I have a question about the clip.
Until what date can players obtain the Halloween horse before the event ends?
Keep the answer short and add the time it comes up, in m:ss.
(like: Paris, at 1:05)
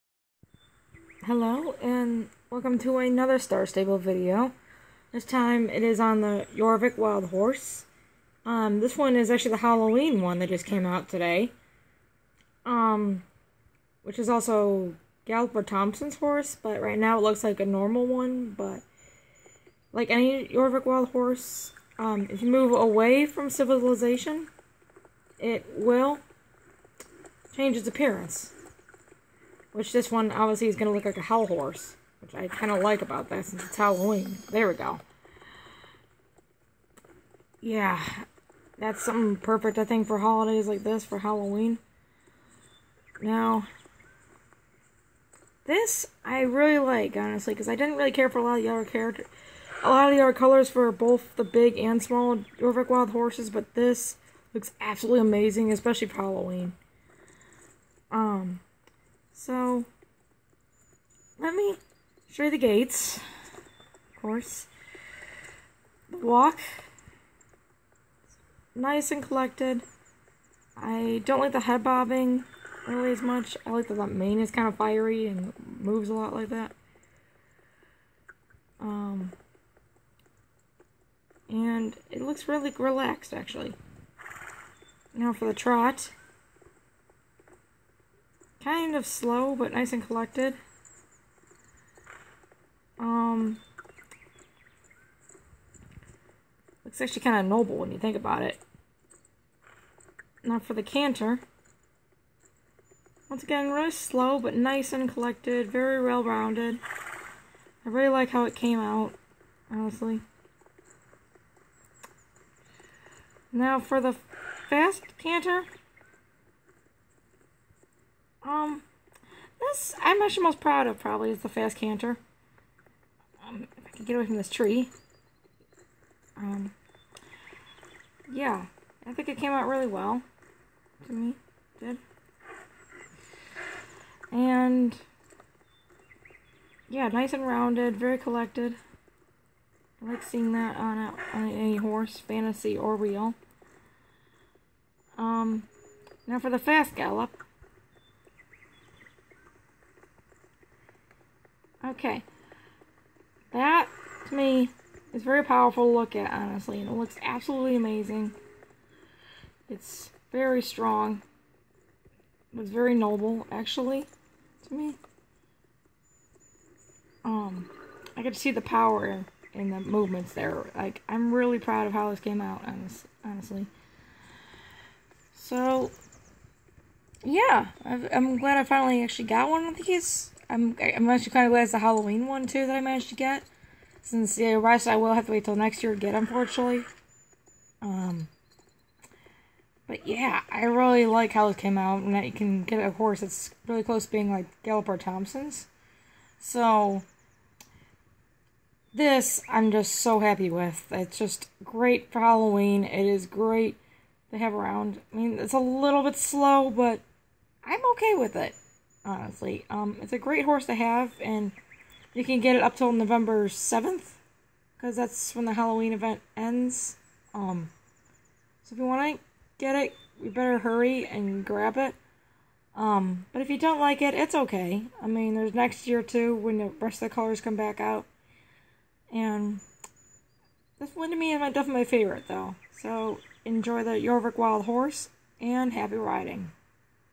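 November 7th, at 3:32.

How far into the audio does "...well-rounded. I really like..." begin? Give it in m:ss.
1:46.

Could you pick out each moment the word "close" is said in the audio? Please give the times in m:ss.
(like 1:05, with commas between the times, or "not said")
3:13.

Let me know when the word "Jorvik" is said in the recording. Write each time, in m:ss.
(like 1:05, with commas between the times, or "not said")
0:06, 0:20, 3:53.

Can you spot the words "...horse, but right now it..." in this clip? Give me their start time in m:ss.
0:16.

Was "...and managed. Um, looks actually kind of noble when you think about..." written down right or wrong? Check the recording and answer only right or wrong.
wrong.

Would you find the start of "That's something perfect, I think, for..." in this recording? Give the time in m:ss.
0:38.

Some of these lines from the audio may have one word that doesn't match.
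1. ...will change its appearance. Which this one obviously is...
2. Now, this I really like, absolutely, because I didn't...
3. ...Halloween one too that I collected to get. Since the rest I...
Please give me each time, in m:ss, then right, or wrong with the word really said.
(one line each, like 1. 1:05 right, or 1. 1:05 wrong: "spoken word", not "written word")
1. 0:25 right
2. 0:43 wrong: "honestly", not "absolutely"
3. 3:01 wrong: "managed", not "collected".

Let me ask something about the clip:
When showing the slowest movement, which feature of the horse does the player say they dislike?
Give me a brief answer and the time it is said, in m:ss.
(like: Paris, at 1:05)
head bobbing, at 1:11.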